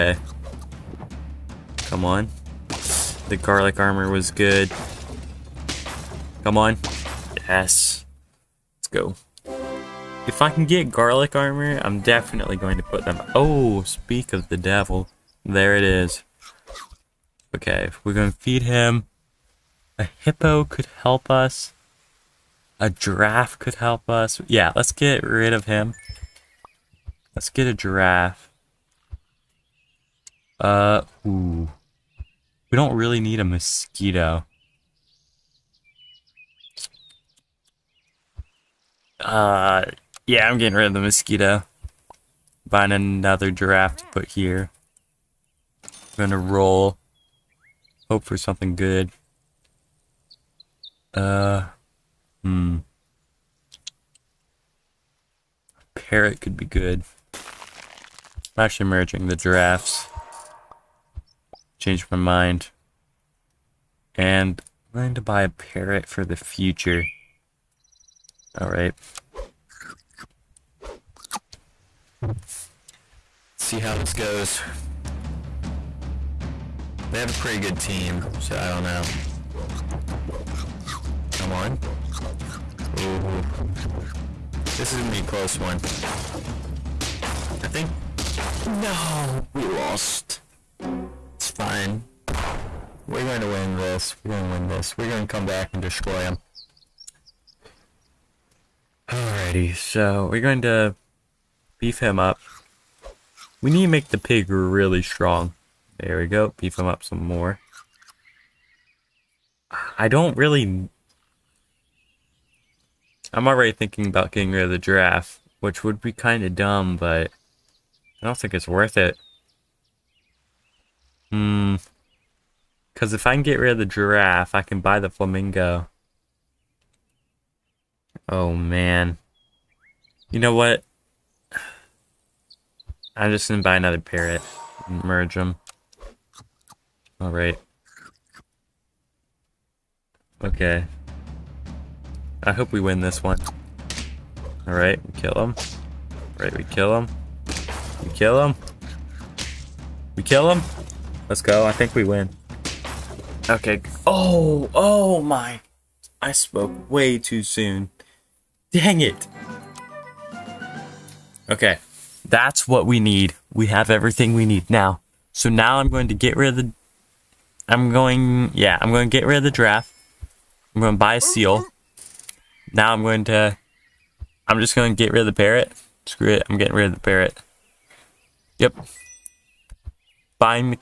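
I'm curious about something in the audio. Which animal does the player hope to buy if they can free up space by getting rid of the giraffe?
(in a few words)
Flamingo.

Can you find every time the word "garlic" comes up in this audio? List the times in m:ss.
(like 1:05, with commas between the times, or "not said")
0:03, 0:10.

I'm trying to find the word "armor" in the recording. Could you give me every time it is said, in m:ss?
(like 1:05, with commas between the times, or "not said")
0:03, 0:11.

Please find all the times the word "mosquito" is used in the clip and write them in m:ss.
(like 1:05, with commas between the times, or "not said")
0:33, 0:41.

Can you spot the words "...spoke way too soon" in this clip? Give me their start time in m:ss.
2:36.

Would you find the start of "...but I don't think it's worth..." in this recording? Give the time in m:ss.
1:56.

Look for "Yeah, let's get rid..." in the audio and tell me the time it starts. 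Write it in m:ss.
0:24.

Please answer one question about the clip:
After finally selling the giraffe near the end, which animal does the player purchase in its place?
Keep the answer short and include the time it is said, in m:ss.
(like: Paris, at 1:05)
Seal, at 2:51.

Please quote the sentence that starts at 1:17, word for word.
They have a pretty good team, so I don't know.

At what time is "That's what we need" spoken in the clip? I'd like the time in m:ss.
2:42.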